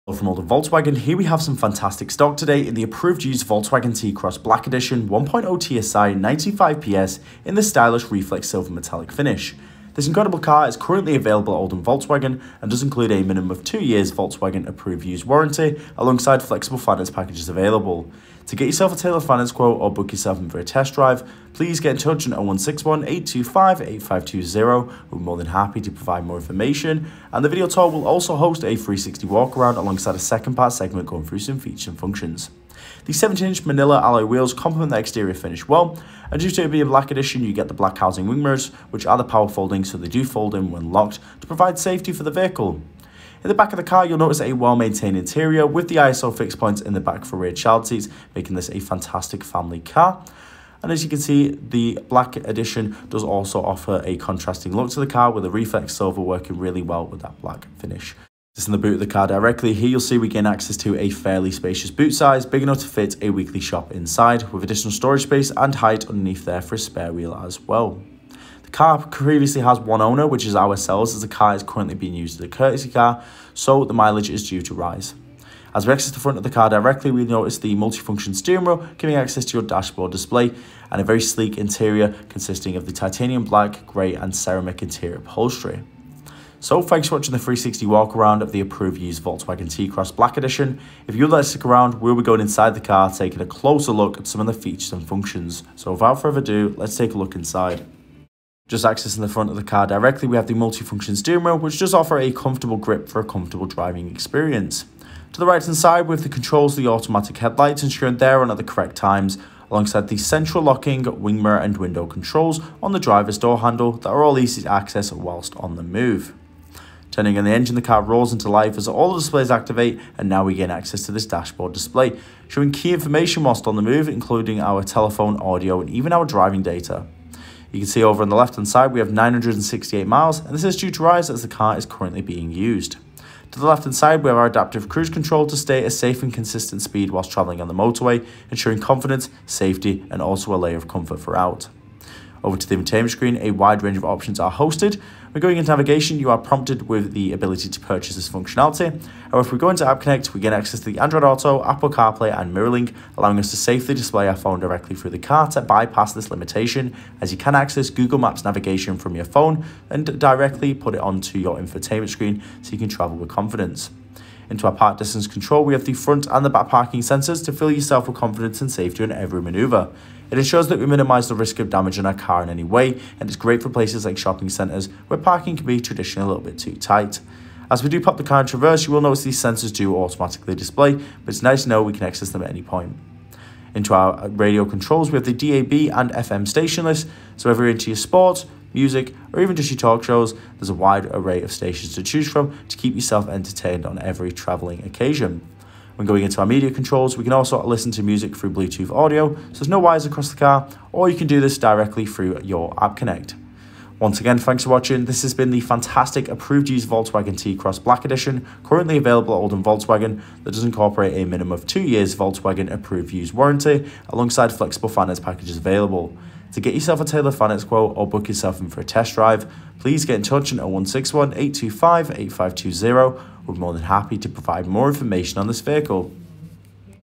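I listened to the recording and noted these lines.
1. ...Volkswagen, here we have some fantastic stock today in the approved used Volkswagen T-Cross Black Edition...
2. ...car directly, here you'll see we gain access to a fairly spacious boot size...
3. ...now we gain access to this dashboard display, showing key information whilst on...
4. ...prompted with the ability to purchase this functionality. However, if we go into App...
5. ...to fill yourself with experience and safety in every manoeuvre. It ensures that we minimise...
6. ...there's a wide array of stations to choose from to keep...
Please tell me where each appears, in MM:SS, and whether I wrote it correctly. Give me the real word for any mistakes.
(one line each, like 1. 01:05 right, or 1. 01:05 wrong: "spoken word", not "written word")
1. 00:00 right
2. 00:59 right
3. 02:00 right
4. 02:26 right
5. 02:47 wrong: "confidence", not "experience"
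6. 03:10 right.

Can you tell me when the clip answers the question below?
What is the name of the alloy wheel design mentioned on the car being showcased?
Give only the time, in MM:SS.
00:33.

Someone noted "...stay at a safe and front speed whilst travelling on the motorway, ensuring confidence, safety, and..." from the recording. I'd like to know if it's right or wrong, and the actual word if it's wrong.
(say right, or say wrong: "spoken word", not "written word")
wrong: "consistent", not "front".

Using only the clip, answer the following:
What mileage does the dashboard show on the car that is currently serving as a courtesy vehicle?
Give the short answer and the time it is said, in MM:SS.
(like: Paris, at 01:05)
968, at 02:09.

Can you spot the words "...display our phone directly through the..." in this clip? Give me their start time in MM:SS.
02:33.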